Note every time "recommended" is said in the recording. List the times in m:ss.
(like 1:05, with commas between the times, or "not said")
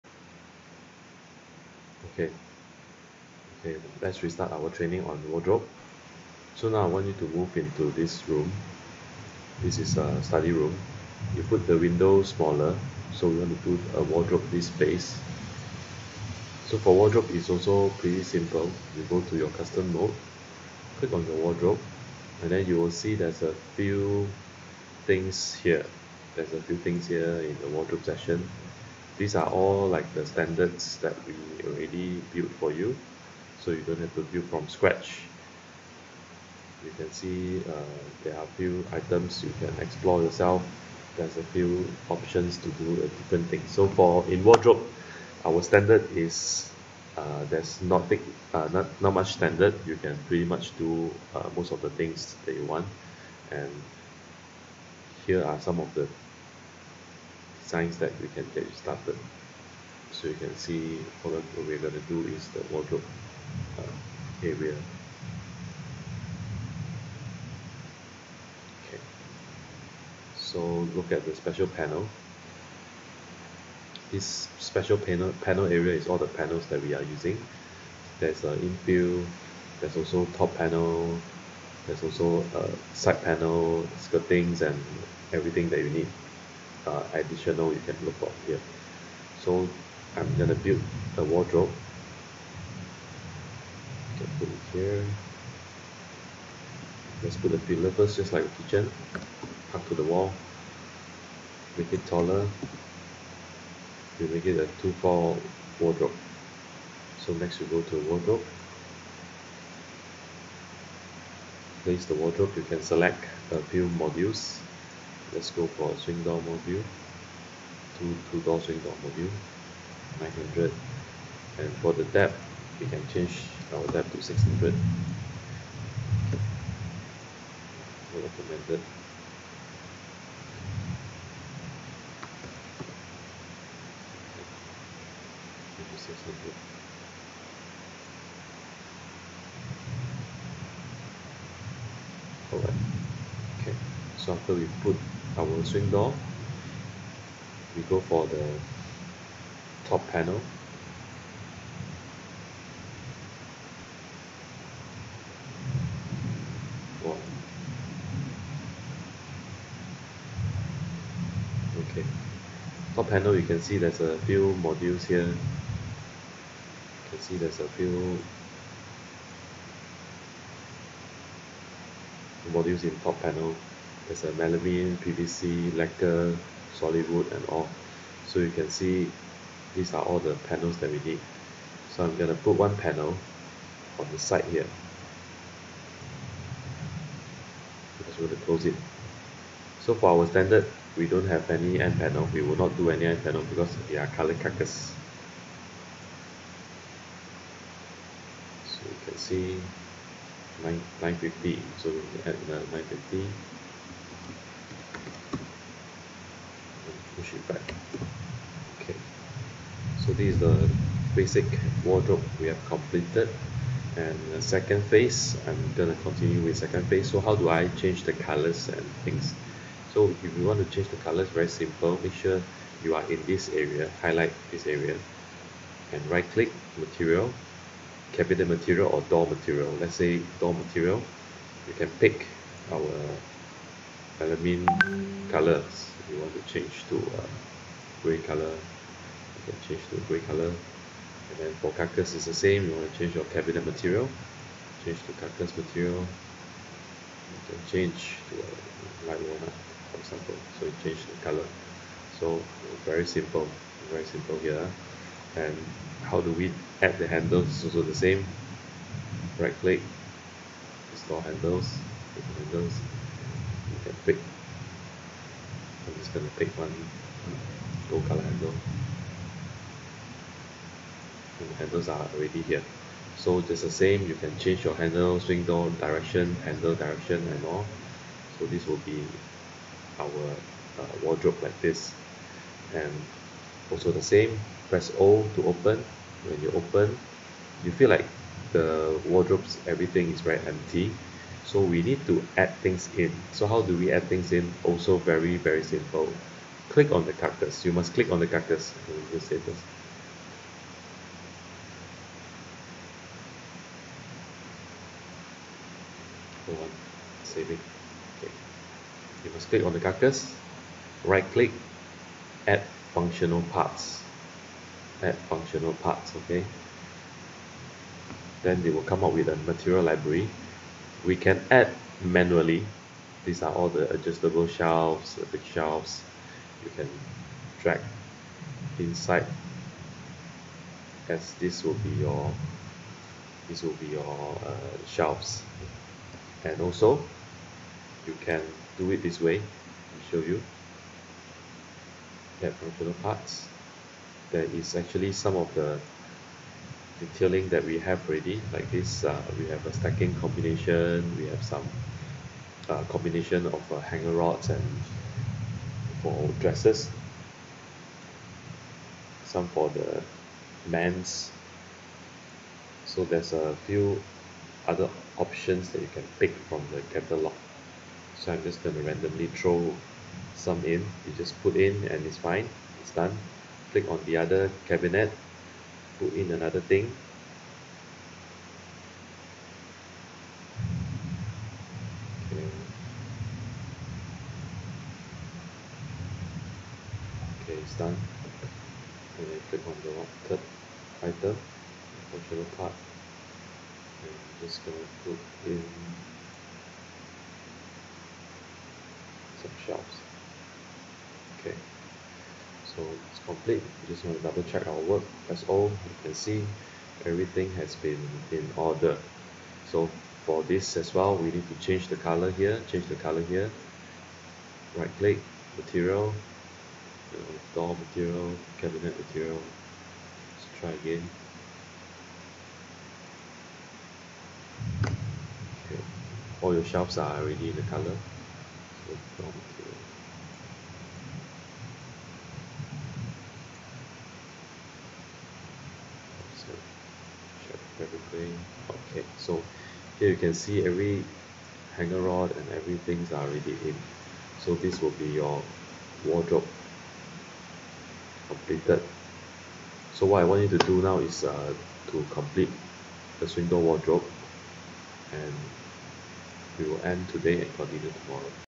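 2:08.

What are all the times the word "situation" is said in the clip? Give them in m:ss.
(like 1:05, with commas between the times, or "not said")
not said.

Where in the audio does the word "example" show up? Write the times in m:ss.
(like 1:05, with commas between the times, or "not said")
4:09.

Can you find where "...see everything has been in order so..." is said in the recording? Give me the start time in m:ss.
6:46.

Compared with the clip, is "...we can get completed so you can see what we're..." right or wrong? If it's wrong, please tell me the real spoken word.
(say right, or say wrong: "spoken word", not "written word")
wrong: "started", not "completed".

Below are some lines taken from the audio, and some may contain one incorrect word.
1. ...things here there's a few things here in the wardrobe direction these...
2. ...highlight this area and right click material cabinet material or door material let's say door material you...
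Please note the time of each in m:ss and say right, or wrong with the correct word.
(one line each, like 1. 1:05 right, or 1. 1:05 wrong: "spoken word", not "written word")
1. 0:25 wrong: "section", not "direction"
2. 3:44 right.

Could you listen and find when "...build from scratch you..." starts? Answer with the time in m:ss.
0:34.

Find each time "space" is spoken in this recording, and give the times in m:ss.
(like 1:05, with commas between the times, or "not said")
0:14.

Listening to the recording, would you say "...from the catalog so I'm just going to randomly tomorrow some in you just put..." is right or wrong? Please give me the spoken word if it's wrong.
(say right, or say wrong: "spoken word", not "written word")
wrong: "throw", not "tomorrow".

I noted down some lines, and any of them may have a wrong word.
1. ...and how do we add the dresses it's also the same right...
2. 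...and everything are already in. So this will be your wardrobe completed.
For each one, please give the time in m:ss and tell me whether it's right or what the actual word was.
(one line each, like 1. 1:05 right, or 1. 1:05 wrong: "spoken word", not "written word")
1. 4:15 wrong: "handles", not "dresses"
2. 7:22 right.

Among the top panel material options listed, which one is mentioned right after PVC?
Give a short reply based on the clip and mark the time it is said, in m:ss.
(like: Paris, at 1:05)
lacquer, at 2:55.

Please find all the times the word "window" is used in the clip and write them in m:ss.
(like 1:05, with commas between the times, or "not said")
0:11.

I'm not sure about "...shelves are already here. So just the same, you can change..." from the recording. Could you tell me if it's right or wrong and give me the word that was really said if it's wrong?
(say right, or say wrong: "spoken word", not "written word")
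wrong: "handles", not "shelves".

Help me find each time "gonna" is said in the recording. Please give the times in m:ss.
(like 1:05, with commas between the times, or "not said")
1:30, 3:35, 4:26, 6:34.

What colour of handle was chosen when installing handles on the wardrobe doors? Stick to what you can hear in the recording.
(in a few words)
gold.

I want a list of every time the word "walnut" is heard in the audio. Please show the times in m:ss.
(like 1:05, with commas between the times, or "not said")
4:09.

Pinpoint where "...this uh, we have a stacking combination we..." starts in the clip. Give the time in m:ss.
5:48.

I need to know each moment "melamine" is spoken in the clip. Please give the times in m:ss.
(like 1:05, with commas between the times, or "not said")
2:54, 3:54.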